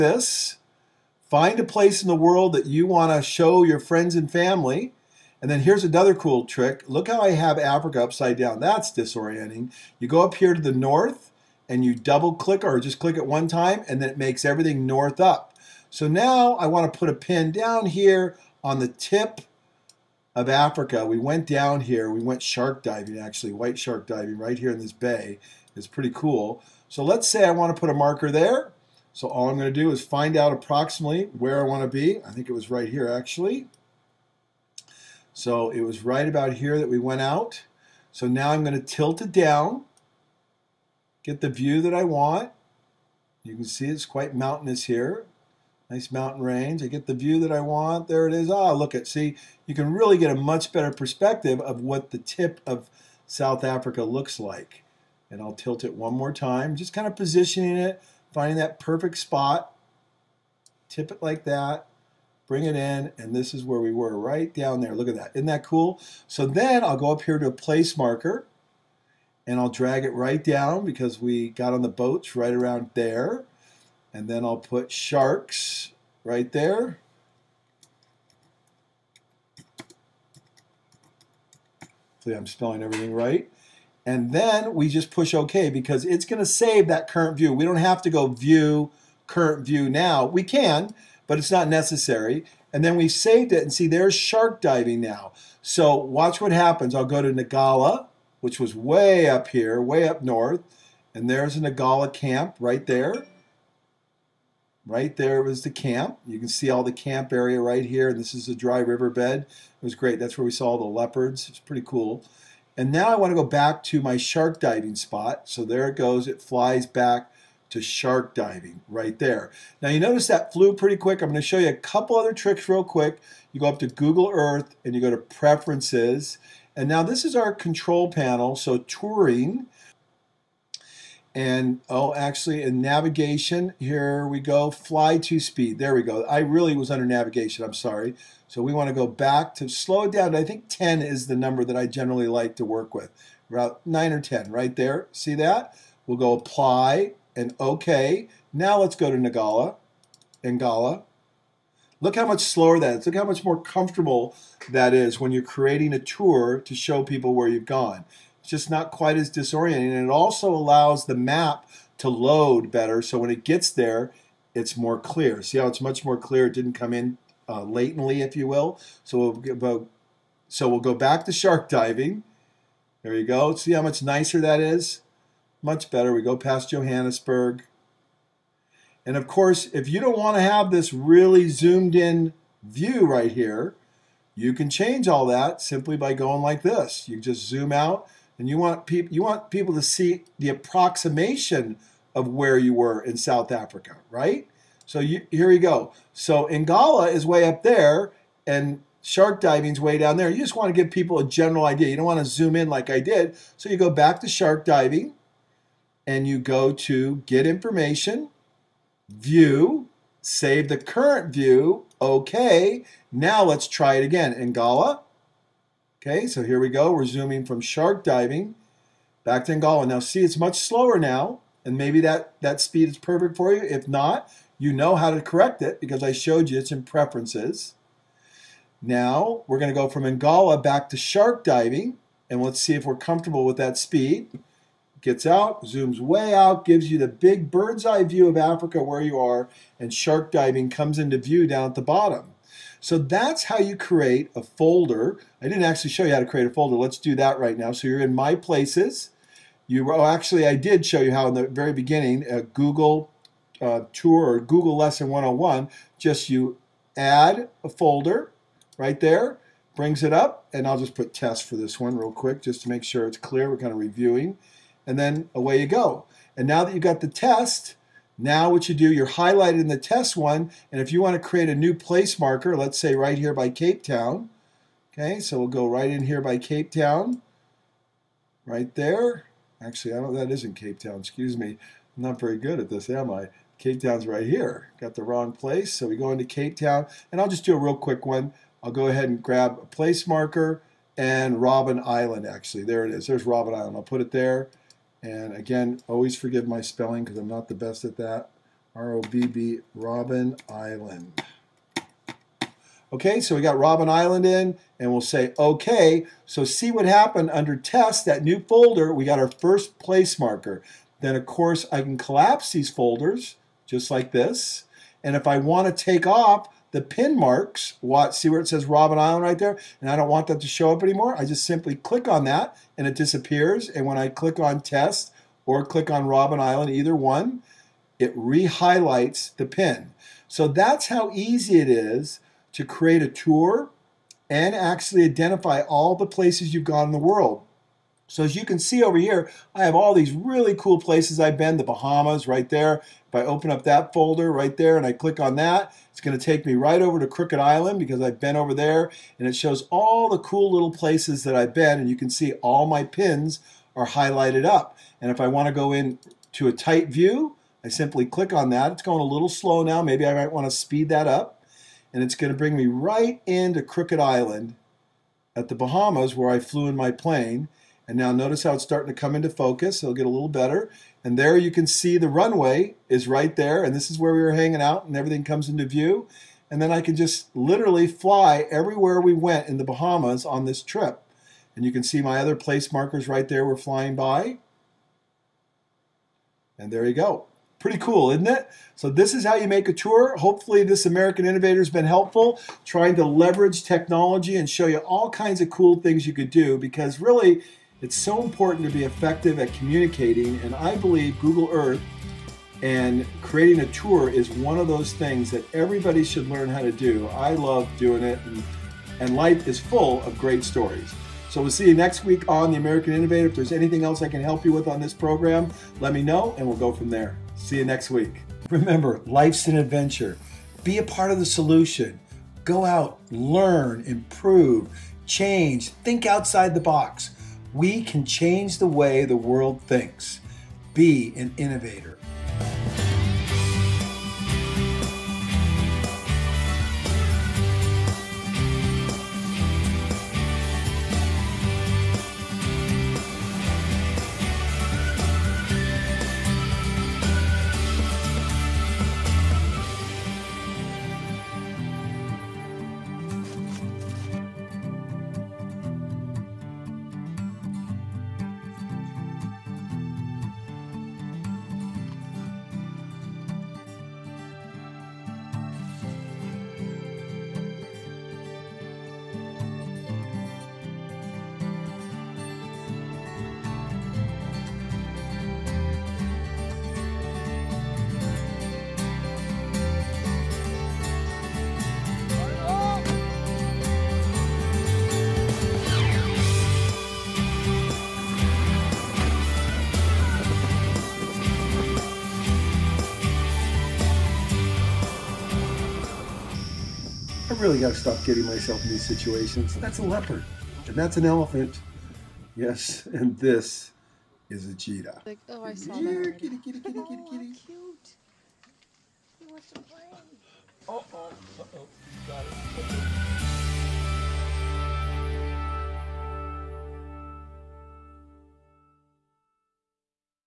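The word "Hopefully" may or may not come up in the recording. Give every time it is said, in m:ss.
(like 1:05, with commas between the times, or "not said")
1:22, 6:30.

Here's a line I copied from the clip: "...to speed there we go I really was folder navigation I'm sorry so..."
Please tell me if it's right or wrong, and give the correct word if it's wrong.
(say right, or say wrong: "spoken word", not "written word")
wrong: "under", not "folder".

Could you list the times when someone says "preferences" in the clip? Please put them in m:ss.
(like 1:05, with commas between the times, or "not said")
2:05, 3:46.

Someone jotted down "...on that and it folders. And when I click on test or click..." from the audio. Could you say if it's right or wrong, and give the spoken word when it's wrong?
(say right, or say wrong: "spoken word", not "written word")
wrong: "disappears", not "folders".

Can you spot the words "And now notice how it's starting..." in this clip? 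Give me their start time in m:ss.
6:07.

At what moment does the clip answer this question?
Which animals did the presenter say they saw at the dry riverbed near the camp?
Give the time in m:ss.
1:50.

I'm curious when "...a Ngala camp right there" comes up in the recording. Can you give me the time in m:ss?
1:41.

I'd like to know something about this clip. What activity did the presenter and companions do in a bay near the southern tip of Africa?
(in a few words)
White shark diving.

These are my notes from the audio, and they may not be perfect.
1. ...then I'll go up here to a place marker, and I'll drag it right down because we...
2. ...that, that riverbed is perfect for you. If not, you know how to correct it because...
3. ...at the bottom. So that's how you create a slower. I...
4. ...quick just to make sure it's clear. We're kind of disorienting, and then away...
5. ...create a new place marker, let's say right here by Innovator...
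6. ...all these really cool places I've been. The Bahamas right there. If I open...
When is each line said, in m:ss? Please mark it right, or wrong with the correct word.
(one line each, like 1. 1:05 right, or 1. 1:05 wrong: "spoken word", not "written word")
1. 1:06 right
2. 3:41 wrong: "speed", not "riverbed"
3. 4:01 wrong: "folder", not "slower"
4. 4:22 wrong: "reviewing", not "disorienting"
5. 4:31 wrong: "Cape", not "Innovator"
6. 5:39 right.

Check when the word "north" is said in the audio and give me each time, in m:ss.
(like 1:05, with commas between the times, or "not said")
0:10, 0:14, 1:40.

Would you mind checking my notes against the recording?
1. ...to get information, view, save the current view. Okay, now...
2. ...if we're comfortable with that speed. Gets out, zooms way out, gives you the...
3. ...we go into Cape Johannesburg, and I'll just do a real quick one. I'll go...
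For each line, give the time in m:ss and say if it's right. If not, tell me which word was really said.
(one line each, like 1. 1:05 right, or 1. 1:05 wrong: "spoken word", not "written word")
1. 3:26 right
2. 3:52 right
3. 4:45 wrong: "Town", not "Johannesburg".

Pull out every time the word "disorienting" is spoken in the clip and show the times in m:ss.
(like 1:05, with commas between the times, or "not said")
0:08, 2:39.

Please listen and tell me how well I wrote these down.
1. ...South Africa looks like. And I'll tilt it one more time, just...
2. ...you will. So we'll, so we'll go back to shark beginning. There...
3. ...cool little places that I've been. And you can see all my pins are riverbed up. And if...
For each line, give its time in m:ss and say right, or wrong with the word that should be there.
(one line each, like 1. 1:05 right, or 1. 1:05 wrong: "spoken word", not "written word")
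1. 0:53 right
2. 2:48 wrong: "diving", not "beginning"
3. 5:50 wrong: "highlighted", not "riverbed".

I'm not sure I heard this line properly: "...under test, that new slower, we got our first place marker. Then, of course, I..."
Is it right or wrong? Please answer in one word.
wrong.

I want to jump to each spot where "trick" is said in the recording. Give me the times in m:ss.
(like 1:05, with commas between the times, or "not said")
0:06, 2:02.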